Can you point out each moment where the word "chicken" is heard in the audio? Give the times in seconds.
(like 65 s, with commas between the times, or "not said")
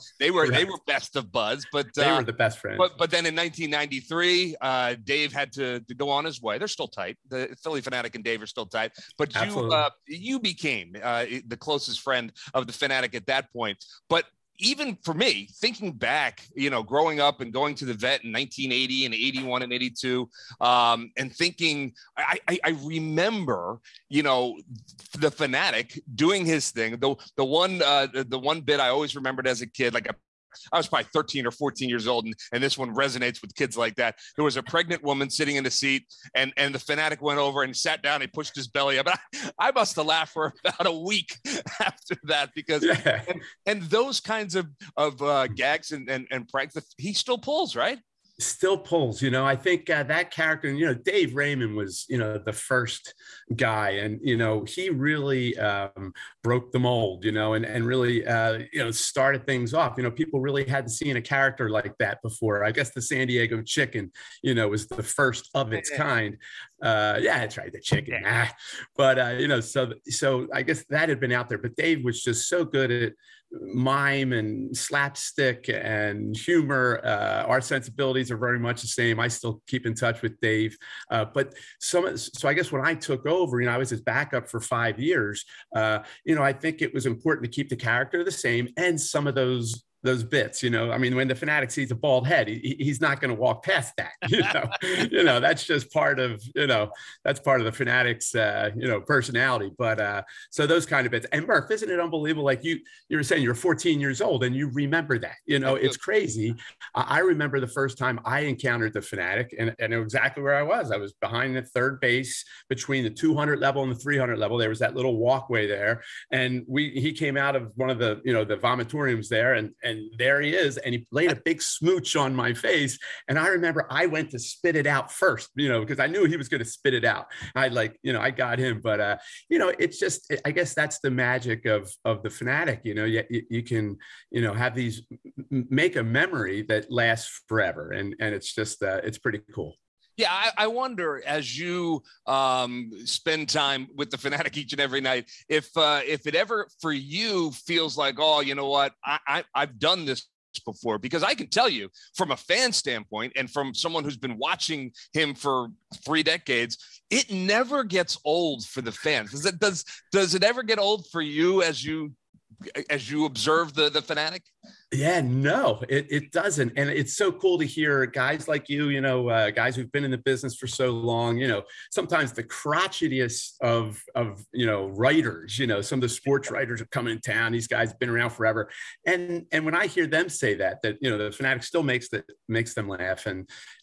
63 s, 67 s.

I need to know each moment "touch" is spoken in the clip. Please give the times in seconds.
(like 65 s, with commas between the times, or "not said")
79 s.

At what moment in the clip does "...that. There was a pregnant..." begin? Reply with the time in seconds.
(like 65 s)
33 s.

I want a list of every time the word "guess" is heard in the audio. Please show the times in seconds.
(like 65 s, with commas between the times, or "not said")
62 s, 70 s, 82 s, 130 s.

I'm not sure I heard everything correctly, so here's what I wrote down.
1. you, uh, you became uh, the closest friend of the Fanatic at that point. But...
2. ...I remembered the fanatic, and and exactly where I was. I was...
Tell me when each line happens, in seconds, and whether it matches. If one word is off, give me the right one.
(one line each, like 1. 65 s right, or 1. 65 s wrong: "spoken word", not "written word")
1. 9 s right
2. 108 s wrong: "encountered", not "remembered".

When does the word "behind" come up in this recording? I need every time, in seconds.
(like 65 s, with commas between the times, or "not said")
111 s.